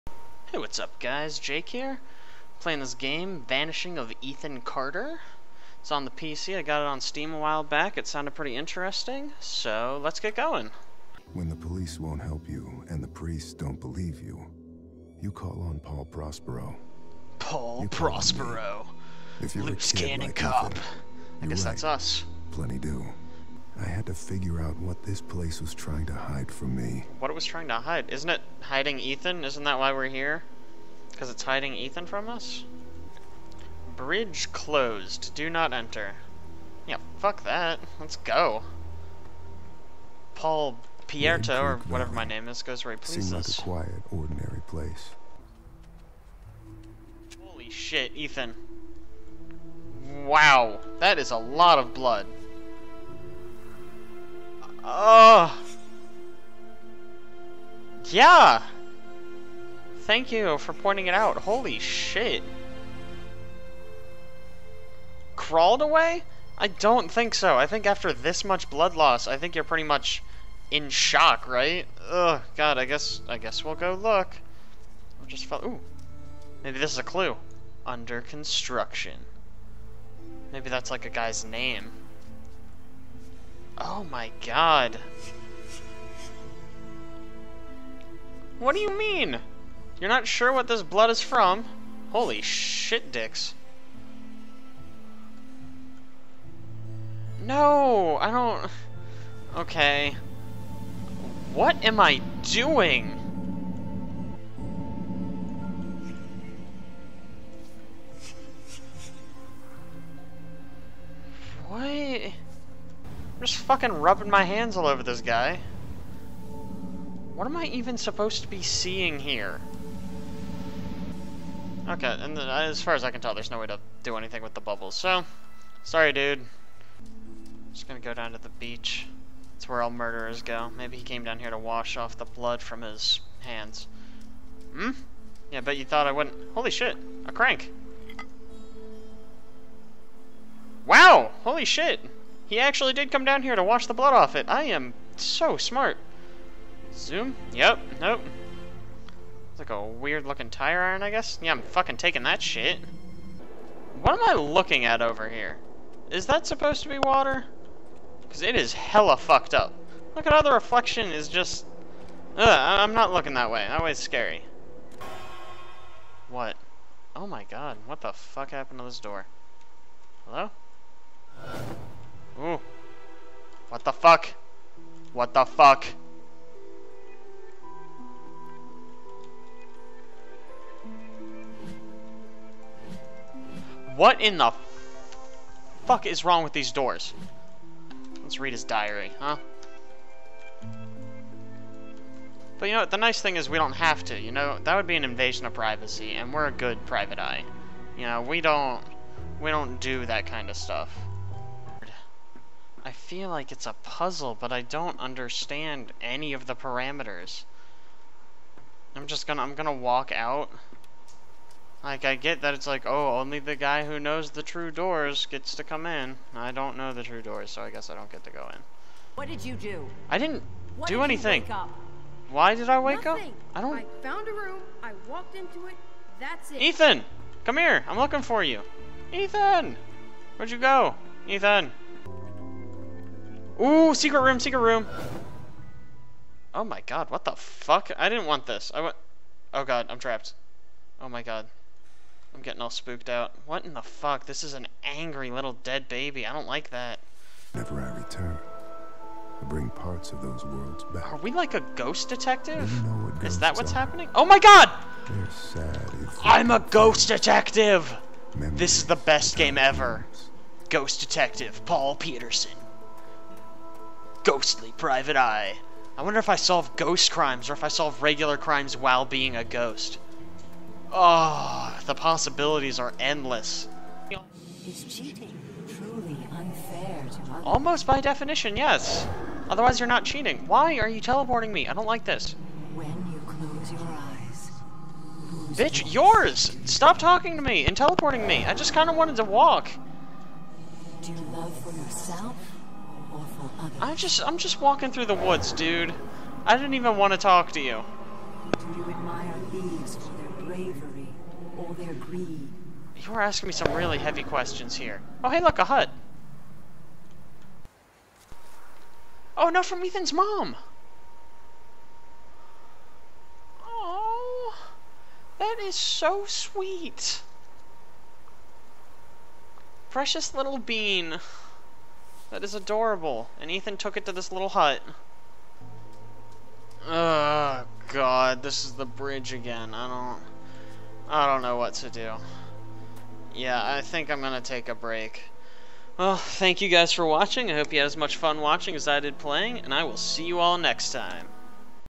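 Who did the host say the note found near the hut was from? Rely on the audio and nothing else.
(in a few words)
Ethan's mom.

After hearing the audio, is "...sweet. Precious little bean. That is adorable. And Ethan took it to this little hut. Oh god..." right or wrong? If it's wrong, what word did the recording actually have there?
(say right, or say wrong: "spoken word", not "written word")
right.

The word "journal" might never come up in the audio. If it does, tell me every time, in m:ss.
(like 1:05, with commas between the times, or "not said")
not said.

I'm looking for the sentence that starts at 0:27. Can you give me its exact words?
What it was trying to hide?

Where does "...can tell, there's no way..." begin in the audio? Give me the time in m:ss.
2:03.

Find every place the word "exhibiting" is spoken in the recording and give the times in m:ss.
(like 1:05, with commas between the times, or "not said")
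not said.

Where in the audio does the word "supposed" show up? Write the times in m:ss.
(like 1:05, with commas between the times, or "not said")
1:57, 2:36.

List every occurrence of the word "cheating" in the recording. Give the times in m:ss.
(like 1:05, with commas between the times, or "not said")
4:34, 4:40.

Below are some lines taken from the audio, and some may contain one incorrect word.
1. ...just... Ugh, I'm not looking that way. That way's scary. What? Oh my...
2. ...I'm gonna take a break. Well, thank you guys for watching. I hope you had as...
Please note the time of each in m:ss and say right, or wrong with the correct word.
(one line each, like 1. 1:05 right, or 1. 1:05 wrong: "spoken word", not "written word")
1. 2:41 right
2. 5:34 right.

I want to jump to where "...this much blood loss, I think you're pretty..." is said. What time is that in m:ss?
1:08.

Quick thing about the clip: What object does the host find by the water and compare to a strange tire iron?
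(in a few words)
A crank.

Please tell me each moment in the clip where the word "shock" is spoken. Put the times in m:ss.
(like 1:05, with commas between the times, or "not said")
1:10.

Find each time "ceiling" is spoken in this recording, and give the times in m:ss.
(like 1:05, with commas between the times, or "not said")
not said.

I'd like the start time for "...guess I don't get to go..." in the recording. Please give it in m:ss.
3:37.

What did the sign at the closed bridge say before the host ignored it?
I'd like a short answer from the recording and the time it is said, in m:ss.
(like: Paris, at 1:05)
Do not enter, at 0:35.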